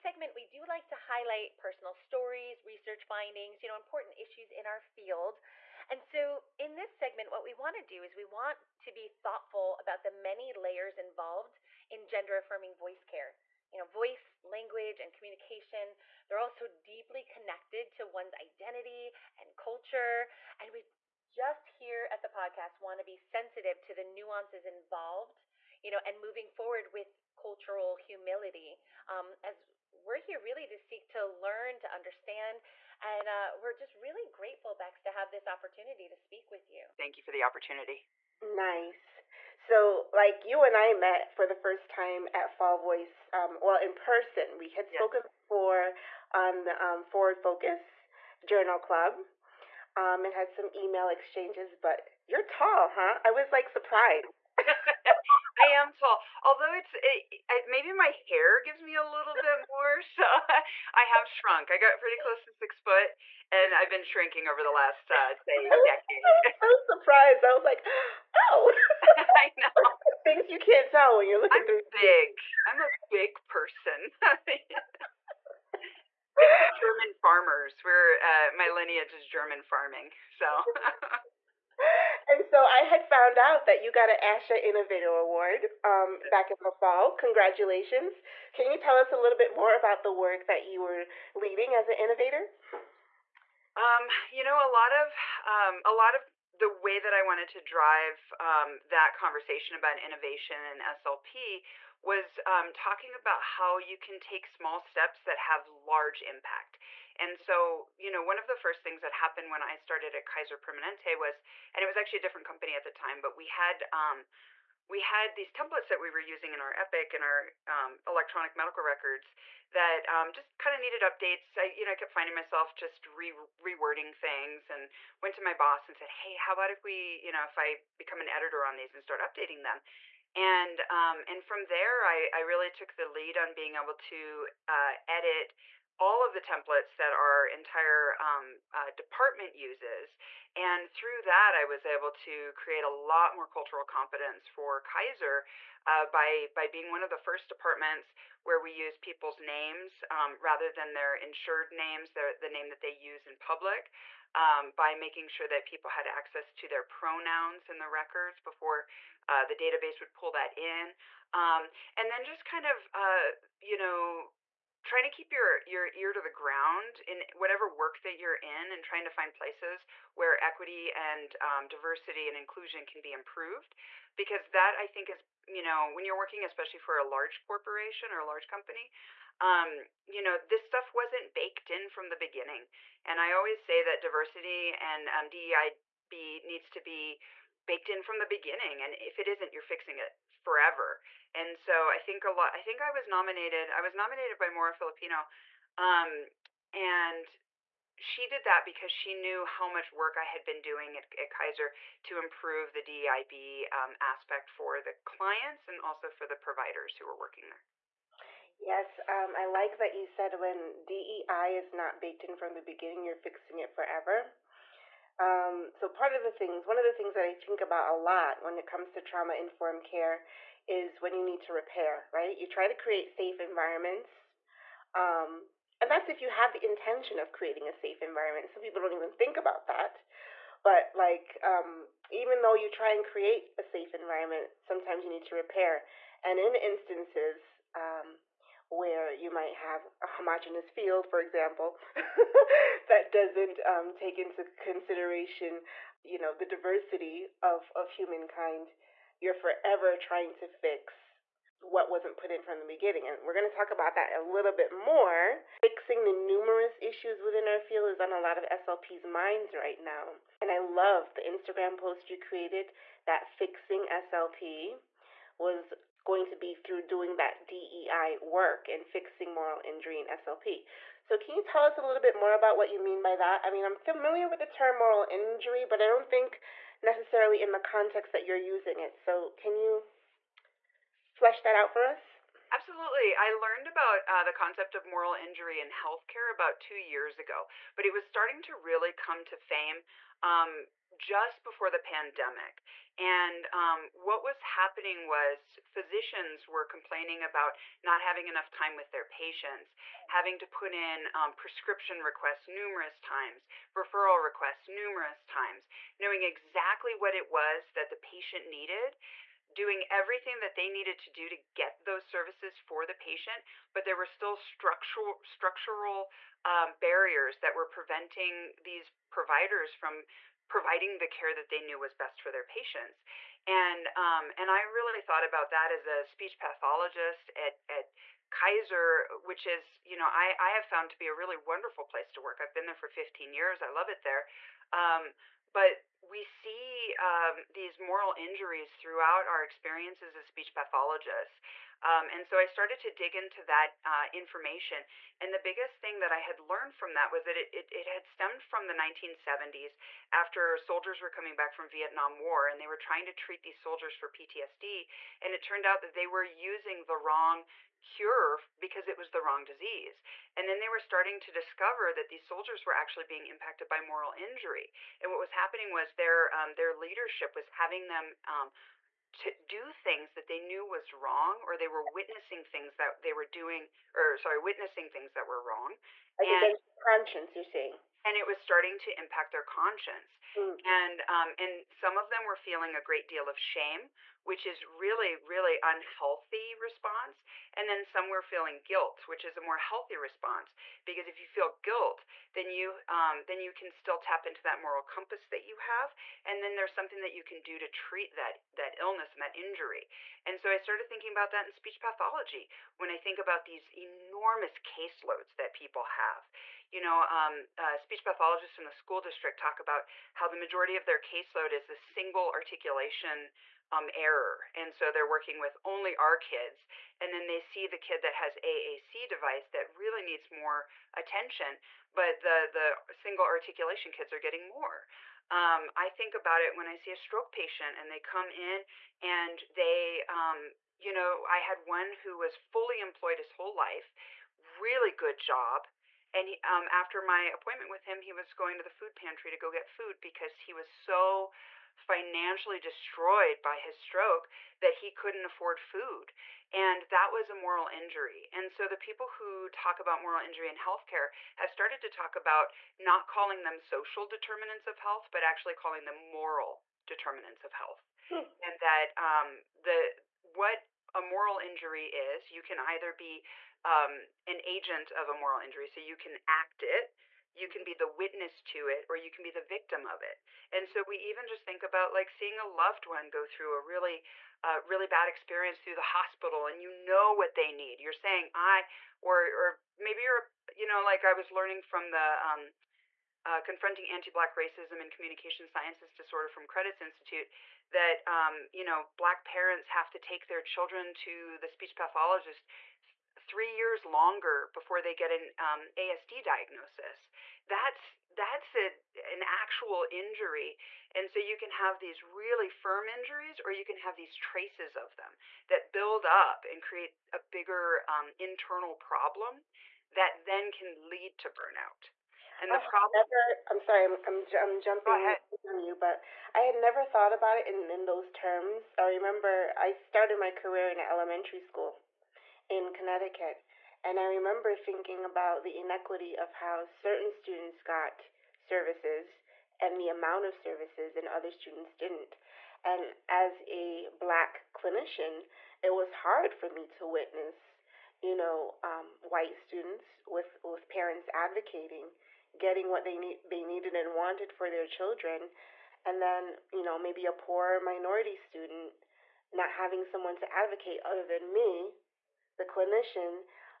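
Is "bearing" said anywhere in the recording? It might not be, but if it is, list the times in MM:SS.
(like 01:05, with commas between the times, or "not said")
not said.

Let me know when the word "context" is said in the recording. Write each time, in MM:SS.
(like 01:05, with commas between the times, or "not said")
04:37.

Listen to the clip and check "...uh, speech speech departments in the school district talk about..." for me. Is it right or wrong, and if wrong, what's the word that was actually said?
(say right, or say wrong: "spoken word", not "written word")
wrong: "pathologists", not "departments".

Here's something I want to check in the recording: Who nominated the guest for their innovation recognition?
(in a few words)
Mora Filipino.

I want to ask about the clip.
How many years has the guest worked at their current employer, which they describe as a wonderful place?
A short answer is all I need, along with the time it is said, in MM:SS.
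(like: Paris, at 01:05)
15, at 05:32.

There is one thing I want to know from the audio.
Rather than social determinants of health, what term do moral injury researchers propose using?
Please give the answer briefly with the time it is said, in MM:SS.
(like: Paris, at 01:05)
moral determinants of health, at 07:36.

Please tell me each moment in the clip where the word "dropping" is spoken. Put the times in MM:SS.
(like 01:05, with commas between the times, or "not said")
not said.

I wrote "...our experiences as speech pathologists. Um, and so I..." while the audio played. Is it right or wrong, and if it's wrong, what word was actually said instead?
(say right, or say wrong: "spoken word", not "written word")
right.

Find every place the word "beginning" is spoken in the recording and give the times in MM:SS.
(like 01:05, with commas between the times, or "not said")
03:02, 03:08, 03:32, 04:12.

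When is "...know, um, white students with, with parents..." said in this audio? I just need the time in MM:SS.
08:58.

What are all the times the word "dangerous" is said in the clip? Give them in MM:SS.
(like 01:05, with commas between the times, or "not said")
not said.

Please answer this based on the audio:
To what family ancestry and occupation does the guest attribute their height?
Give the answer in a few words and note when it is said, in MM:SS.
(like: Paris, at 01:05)
German farmers, at 01:16.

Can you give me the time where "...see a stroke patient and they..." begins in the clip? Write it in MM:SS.
07:06.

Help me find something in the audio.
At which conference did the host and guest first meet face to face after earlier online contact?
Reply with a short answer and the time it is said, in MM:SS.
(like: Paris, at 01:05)
Fall Voice, at 00:42.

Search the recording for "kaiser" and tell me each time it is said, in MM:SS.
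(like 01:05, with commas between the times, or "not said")
01:50, 02:24, 03:21, 05:28.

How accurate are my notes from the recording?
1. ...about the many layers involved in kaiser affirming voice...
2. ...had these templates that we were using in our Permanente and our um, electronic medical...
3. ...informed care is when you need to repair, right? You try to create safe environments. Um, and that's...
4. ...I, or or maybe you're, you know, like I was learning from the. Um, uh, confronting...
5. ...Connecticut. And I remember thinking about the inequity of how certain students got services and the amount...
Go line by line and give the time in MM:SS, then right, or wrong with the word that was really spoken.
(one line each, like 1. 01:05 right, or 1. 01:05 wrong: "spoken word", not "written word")
1. 00:09 wrong: "gender", not "kaiser"
2. 01:54 wrong: "Epic", not "Permanente"
3. 03:39 right
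4. 07:58 right
5. 08:42 right.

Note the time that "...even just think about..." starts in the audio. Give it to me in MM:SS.
07:50.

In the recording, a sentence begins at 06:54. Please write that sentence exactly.
And so they're working with only our kids.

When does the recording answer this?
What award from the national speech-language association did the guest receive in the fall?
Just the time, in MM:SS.
01:24.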